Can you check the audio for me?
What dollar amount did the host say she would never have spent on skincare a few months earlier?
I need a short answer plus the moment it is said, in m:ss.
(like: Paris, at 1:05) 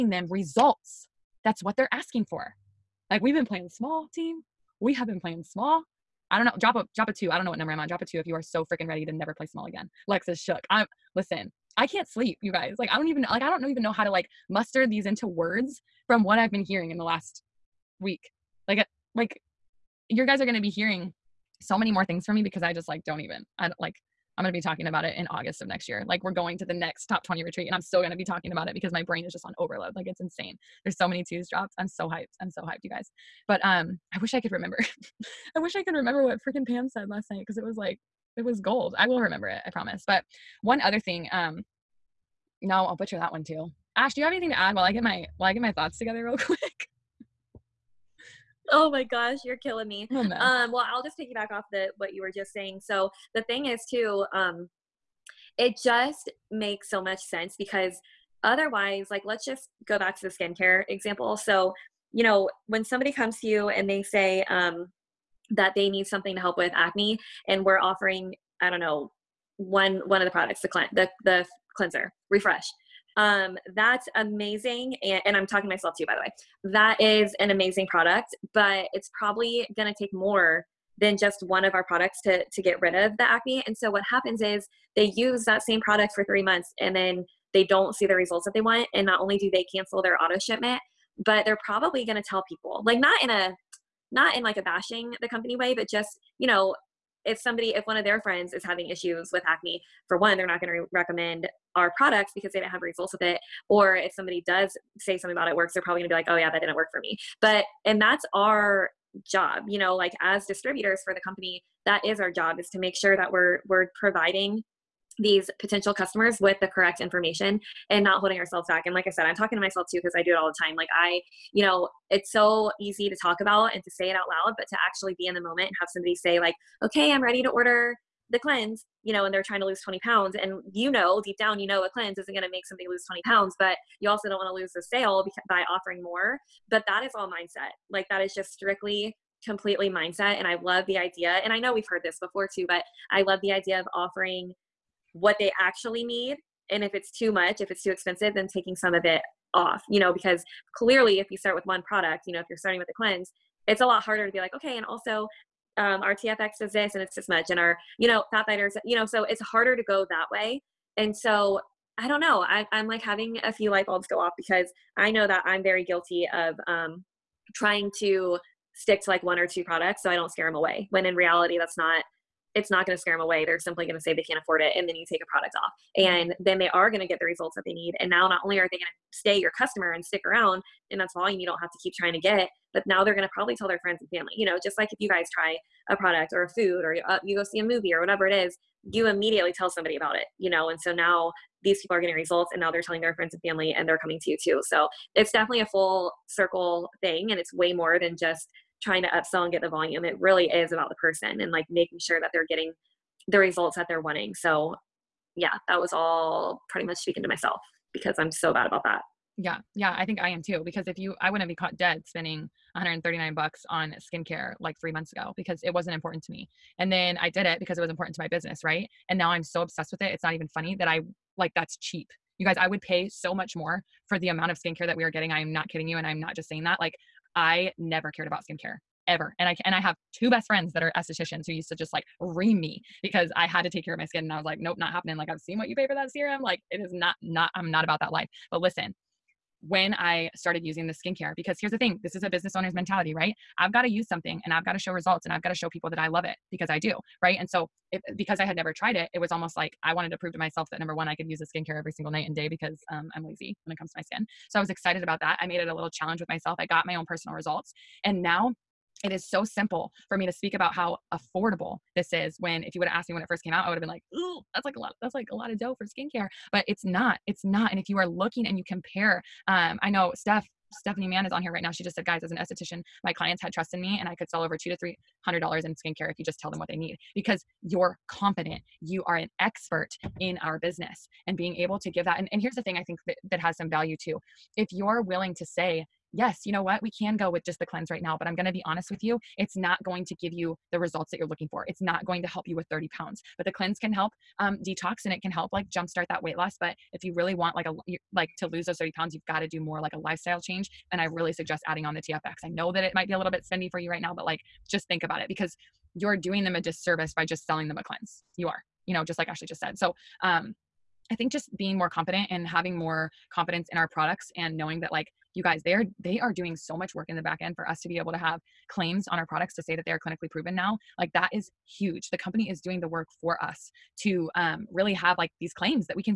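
139, at 3:32.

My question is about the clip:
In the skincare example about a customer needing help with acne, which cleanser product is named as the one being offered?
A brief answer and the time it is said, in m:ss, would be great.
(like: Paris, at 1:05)
Refresh, at 1:12.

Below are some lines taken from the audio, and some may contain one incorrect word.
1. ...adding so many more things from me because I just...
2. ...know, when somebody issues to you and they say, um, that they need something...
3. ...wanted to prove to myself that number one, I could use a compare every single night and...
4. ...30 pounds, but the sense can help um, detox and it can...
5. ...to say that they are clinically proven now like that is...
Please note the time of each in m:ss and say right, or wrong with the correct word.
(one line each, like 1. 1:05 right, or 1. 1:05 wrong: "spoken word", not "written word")
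1. 0:20 wrong: "hearing", not "adding"
2. 1:02 wrong: "comes", not "issues"
3. 4:09 wrong: "skincare", not "compare"
4. 4:52 wrong: "cleanse", not "sense"
5. 5:19 right.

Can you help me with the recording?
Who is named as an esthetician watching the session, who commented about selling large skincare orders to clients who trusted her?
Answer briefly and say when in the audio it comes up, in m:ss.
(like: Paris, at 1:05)
Stephanie Mann, at 4:30.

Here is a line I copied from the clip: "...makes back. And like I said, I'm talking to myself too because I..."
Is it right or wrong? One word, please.
wrong.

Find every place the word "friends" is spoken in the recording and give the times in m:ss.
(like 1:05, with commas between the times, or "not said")
1:38, 3:03, 3:13, 3:50.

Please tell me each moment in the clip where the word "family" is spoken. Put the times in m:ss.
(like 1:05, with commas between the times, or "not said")
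3:04, 3:13.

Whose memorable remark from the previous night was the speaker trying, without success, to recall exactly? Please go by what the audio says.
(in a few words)
Pam.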